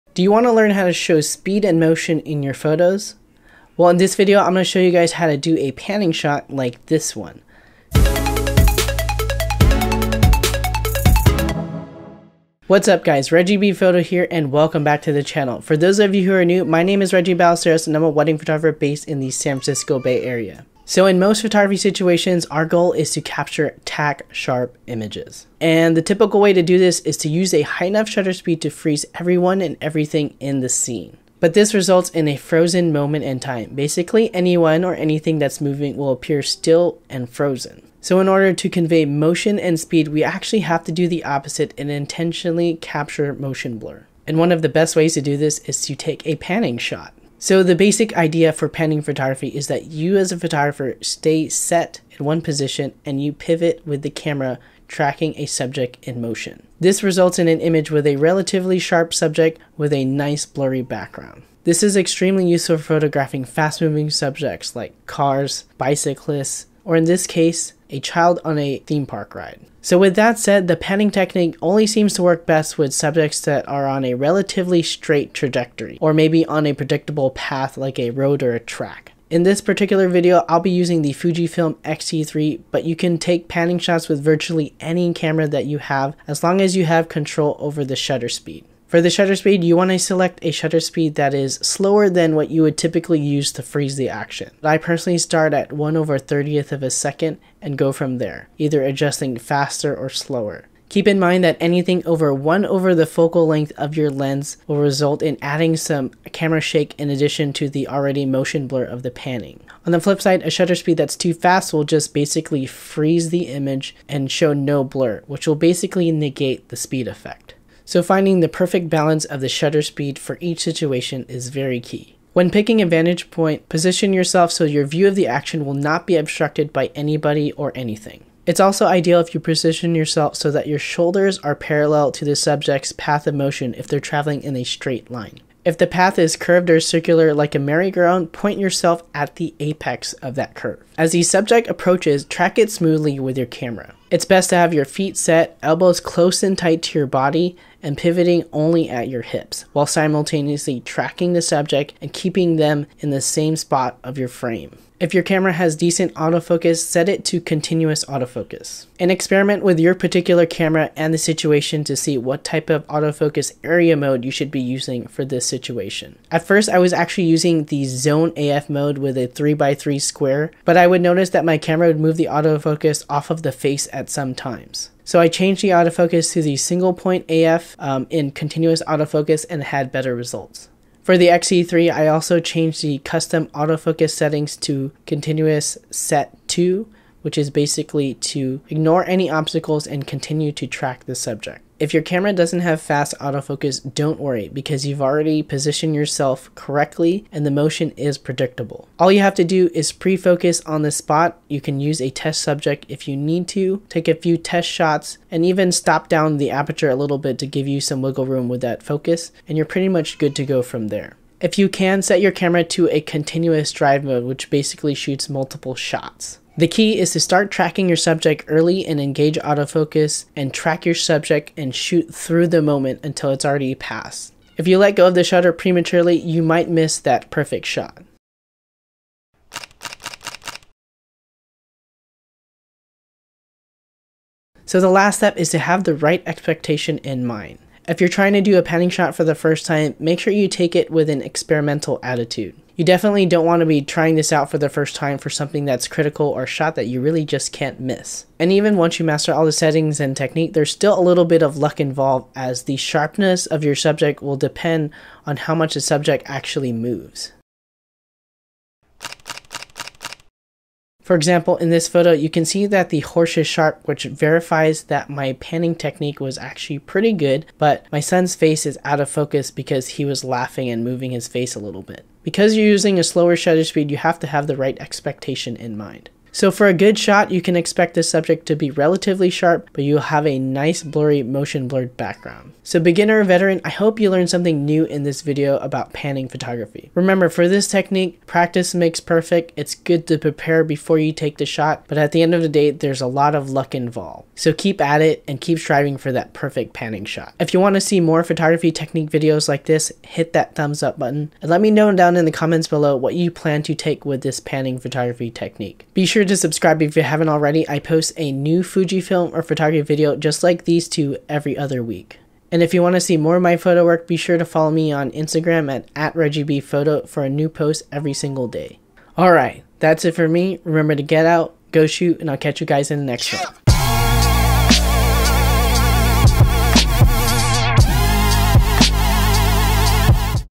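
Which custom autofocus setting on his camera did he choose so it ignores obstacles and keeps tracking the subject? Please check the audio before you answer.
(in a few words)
continuous set 2.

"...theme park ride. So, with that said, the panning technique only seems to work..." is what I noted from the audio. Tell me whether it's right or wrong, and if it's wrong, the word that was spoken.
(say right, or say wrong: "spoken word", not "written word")
right.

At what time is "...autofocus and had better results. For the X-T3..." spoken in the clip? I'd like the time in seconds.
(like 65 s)
178 s.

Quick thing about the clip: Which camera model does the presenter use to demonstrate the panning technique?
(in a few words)
Fujifilm X-T3.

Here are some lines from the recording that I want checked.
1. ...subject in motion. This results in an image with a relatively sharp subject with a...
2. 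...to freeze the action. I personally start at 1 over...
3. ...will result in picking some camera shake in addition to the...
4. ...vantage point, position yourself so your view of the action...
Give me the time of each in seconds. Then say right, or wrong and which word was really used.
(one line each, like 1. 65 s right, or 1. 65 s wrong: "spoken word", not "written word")
1. 55 s right
2. 93 s right
3. 104 s wrong: "adding", not "picking"
4. 122 s right.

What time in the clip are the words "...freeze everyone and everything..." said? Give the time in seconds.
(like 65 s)
28 s.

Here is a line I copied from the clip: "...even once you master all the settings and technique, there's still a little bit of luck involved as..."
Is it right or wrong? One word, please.
right.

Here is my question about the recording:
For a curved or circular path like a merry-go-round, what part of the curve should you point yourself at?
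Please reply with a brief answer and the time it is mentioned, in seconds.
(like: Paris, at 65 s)
the apex, at 139 s.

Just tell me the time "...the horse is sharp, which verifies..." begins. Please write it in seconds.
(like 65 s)
262 s.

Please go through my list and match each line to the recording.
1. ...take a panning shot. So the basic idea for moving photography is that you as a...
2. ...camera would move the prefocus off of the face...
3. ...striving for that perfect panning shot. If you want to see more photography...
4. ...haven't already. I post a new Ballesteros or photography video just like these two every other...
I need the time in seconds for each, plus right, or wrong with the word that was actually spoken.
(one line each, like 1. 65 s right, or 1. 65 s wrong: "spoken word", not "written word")
1. 45 s wrong: "panning", not "moving"
2. 171 s wrong: "autofocus", not "prefocus"
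3. 295 s right
4. 307 s wrong: "Fujifilm", not "Ballesteros".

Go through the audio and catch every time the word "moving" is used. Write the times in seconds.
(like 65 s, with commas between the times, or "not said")
35 s, 63 s, 270 s.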